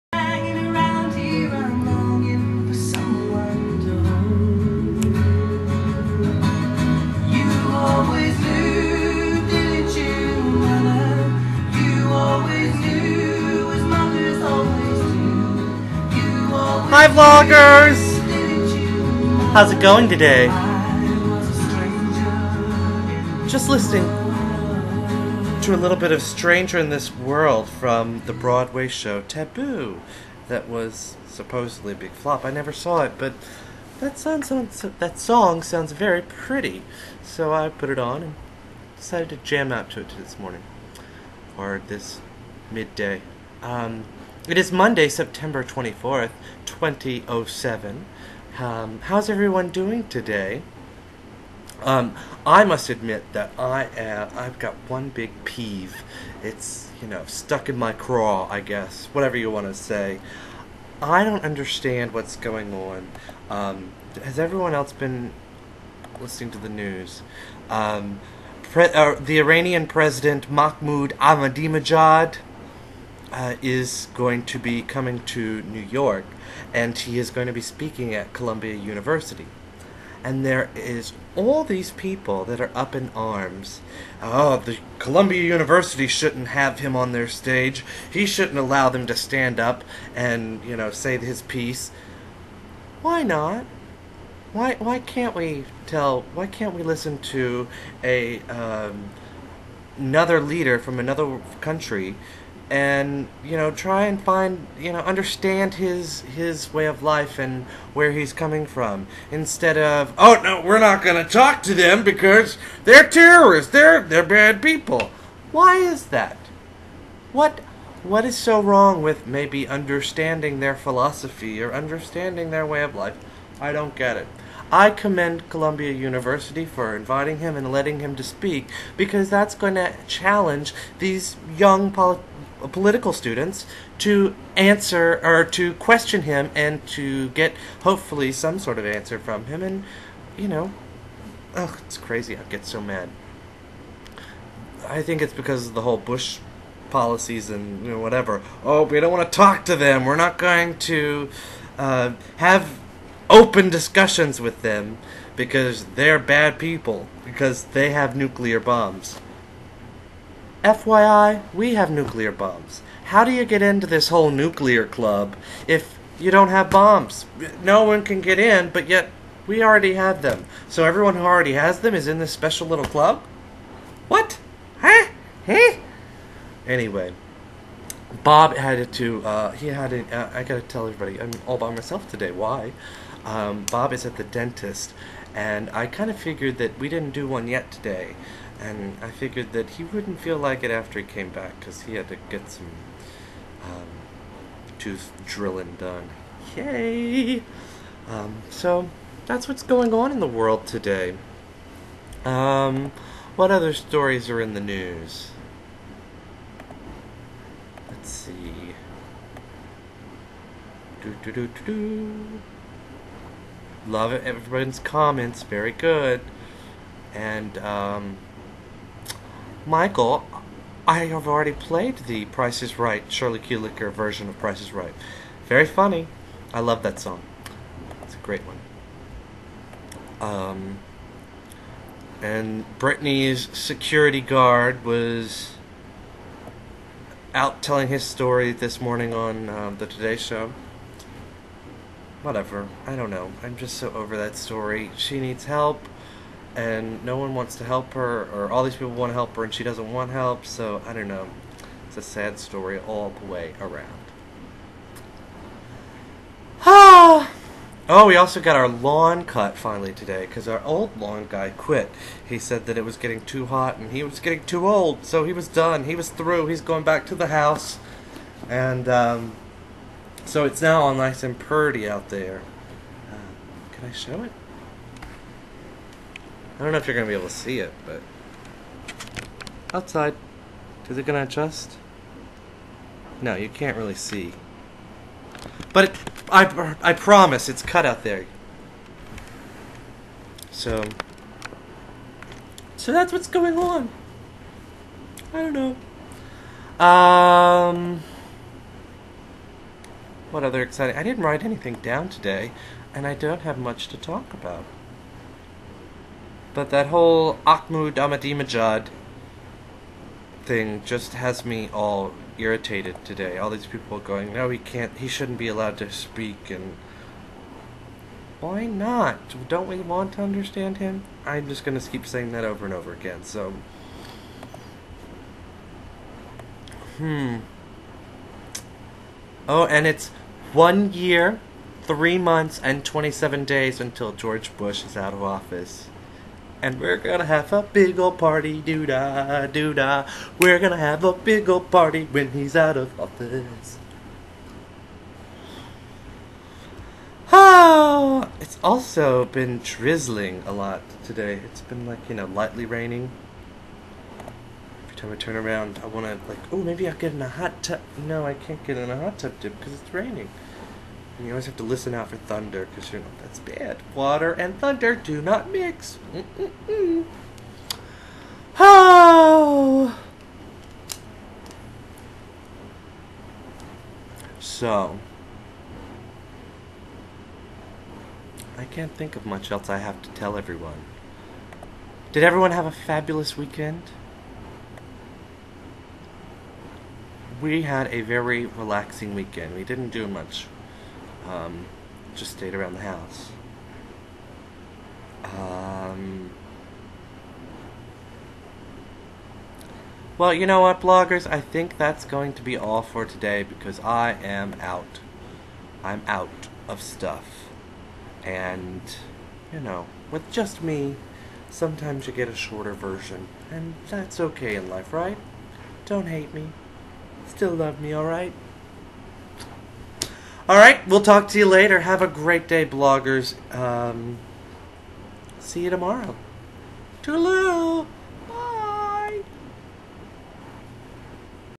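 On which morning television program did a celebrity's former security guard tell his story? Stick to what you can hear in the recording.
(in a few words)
The Today Show.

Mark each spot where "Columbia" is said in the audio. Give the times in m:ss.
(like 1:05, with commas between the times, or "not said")
1:18, 1:24, 2:05.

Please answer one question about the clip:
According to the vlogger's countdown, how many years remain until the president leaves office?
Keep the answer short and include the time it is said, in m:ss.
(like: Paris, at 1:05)
1, at 5:30.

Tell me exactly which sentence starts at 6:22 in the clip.
Did everyone have a fabulous weekend?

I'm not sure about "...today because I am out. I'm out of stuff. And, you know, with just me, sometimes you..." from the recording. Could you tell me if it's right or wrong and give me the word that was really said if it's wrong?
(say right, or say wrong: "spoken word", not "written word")
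right.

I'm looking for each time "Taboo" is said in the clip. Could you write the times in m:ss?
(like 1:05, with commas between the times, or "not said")
0:29.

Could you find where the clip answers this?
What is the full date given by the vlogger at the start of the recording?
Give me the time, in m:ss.
0:44.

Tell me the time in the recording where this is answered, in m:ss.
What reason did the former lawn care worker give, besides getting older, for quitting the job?
4:22.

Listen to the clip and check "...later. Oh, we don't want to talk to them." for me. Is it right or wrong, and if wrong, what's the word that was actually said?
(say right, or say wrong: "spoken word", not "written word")
wrong: "whatever", not "later".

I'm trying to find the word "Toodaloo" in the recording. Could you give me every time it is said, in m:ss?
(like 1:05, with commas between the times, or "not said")
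7:07.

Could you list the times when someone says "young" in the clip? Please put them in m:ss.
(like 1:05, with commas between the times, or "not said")
2:11.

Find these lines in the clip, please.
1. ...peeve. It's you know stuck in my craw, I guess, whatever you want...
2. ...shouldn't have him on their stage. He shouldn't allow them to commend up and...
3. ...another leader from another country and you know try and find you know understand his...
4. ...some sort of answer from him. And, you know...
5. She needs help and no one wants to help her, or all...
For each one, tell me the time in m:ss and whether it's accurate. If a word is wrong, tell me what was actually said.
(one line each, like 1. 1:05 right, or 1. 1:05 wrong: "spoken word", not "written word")
1. 0:55 right
2. 1:26 wrong: "stand", not "commend"
3. 1:39 right
4. 2:18 right
5. 4:04 right.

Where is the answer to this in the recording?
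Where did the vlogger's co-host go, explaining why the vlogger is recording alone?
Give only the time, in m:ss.
3:04.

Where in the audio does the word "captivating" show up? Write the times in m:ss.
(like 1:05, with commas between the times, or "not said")
not said.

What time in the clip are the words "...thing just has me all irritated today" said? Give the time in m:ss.
5:10.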